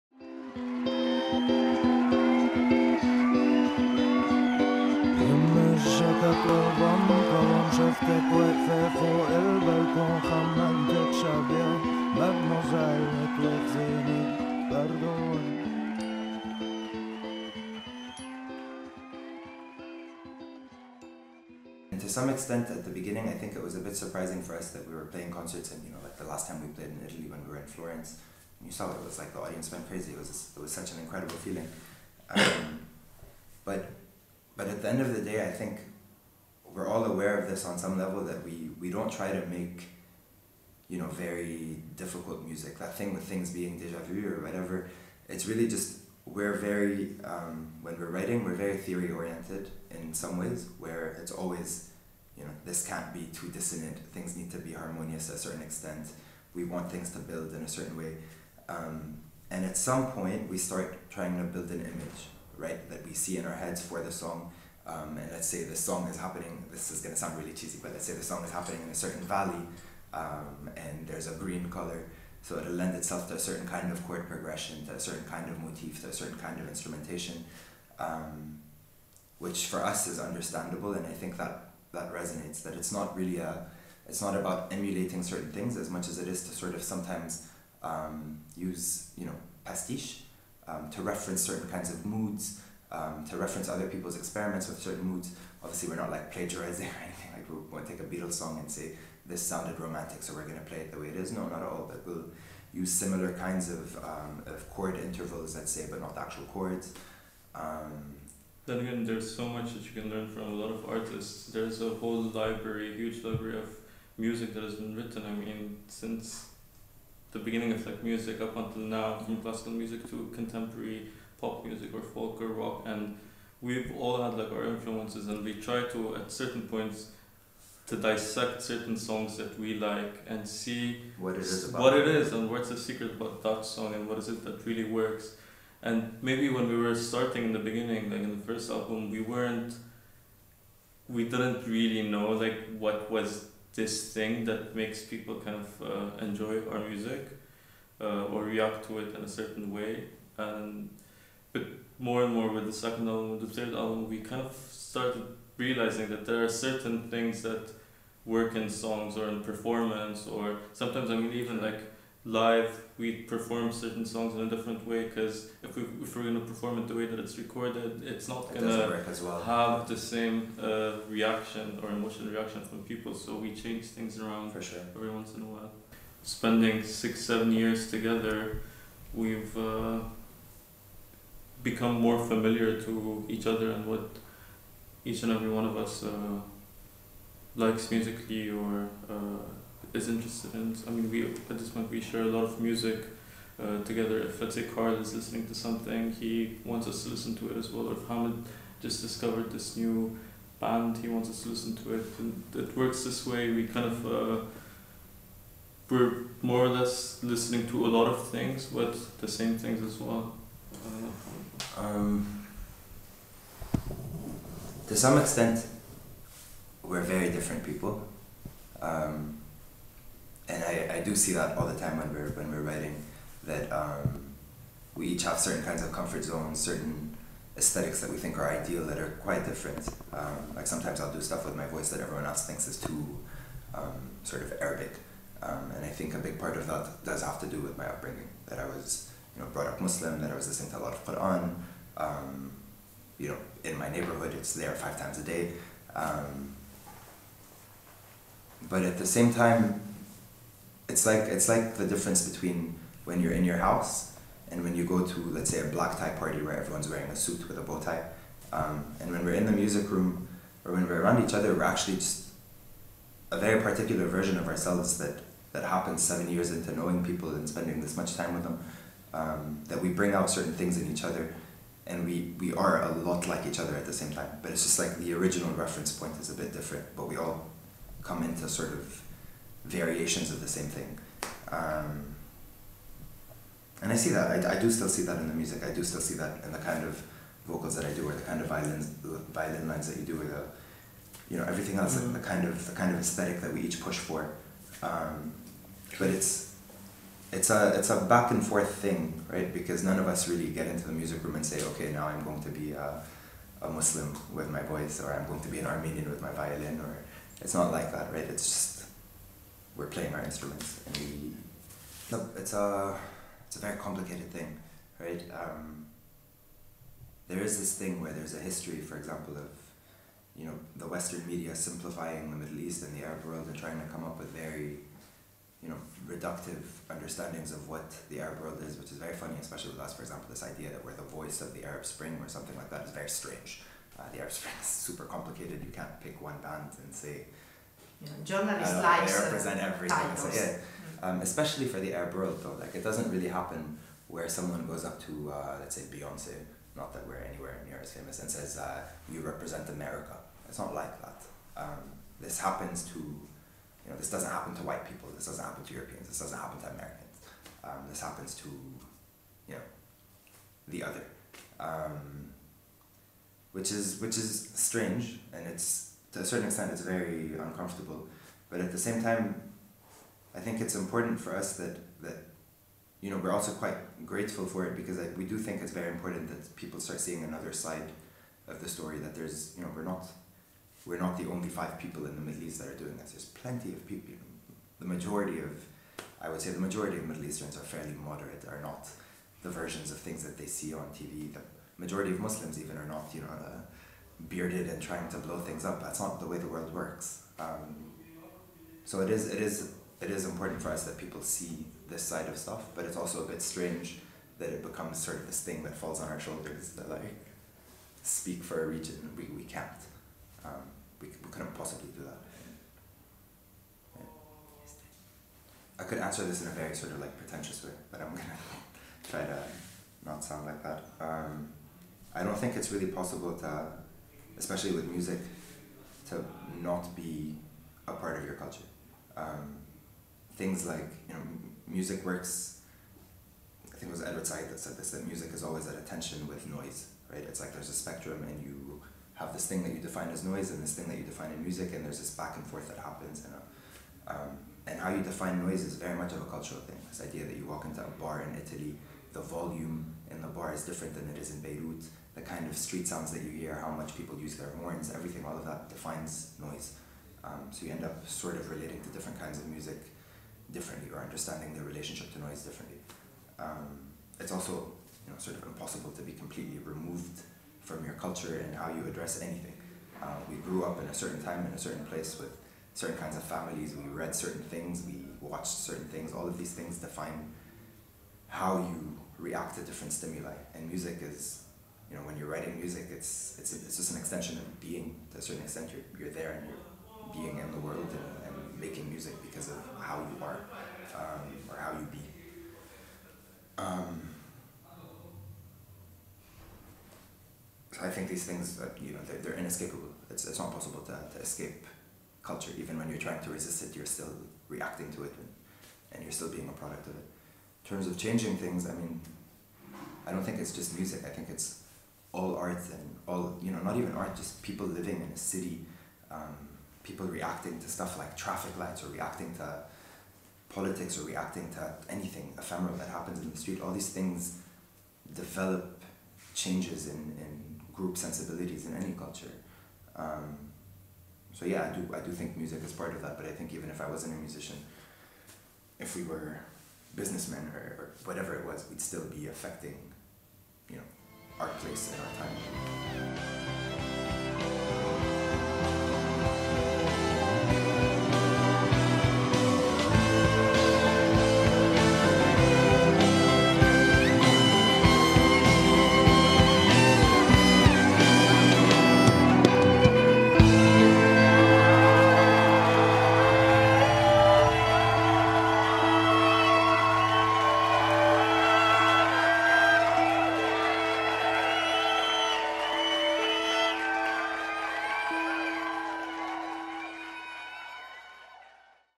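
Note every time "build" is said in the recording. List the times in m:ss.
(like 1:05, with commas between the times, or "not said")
0:57, 1:01.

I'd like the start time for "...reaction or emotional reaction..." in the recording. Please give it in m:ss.
2:51.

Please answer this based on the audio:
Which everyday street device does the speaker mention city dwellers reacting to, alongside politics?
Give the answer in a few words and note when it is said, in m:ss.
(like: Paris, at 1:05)
Traffic lights, at 8:38.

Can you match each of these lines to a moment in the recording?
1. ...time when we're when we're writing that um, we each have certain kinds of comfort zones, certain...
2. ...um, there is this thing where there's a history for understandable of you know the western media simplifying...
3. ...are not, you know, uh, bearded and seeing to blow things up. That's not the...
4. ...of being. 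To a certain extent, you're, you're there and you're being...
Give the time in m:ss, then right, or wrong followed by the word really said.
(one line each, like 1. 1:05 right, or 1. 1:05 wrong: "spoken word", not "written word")
1. 3:41 right
2. 5:15 wrong: "example", not "understandable"
3. 6:32 wrong: "trying", not "seeing"
4. 8:04 right.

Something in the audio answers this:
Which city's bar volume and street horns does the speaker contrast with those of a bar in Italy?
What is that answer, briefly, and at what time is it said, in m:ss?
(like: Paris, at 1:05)
Beirut, at 7:31.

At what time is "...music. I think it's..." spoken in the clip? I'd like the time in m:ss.
8:30.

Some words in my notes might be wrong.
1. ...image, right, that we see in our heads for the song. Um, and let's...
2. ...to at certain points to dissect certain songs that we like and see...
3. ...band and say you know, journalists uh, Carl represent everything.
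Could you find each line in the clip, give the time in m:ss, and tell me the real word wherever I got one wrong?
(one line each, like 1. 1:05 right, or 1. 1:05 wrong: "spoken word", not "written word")
1. 1:01 right
2. 2:05 right
3. 5:36 wrong: "They", not "Carl".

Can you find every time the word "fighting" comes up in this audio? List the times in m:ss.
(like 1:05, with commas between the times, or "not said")
not said.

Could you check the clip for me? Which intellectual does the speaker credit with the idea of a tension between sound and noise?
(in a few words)
Edward Said.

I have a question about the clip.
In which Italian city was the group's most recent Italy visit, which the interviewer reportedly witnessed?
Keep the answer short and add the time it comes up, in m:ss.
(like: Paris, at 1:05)
Florence, at 0:27.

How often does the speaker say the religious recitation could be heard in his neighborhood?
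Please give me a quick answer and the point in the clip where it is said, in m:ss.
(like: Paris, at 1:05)
5 times a day, at 4:04.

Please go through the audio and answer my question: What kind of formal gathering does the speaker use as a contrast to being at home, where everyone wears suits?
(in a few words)
Black tie party.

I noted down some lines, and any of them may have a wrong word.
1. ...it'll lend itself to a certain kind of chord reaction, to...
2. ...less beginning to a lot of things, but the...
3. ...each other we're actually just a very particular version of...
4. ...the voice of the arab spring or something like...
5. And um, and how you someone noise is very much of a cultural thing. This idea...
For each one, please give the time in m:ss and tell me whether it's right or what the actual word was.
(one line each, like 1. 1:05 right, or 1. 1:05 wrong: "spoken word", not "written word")
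1. 1:12 wrong: "progression", not "reaction"
2. 3:26 wrong: "listening", not "beginning"
3. 4:21 right
4. 5:30 right
5. 7:23 wrong: "define", not "someone".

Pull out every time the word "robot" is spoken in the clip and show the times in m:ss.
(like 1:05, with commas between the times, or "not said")
not said.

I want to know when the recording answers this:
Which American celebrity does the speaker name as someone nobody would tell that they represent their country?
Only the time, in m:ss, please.
5:45.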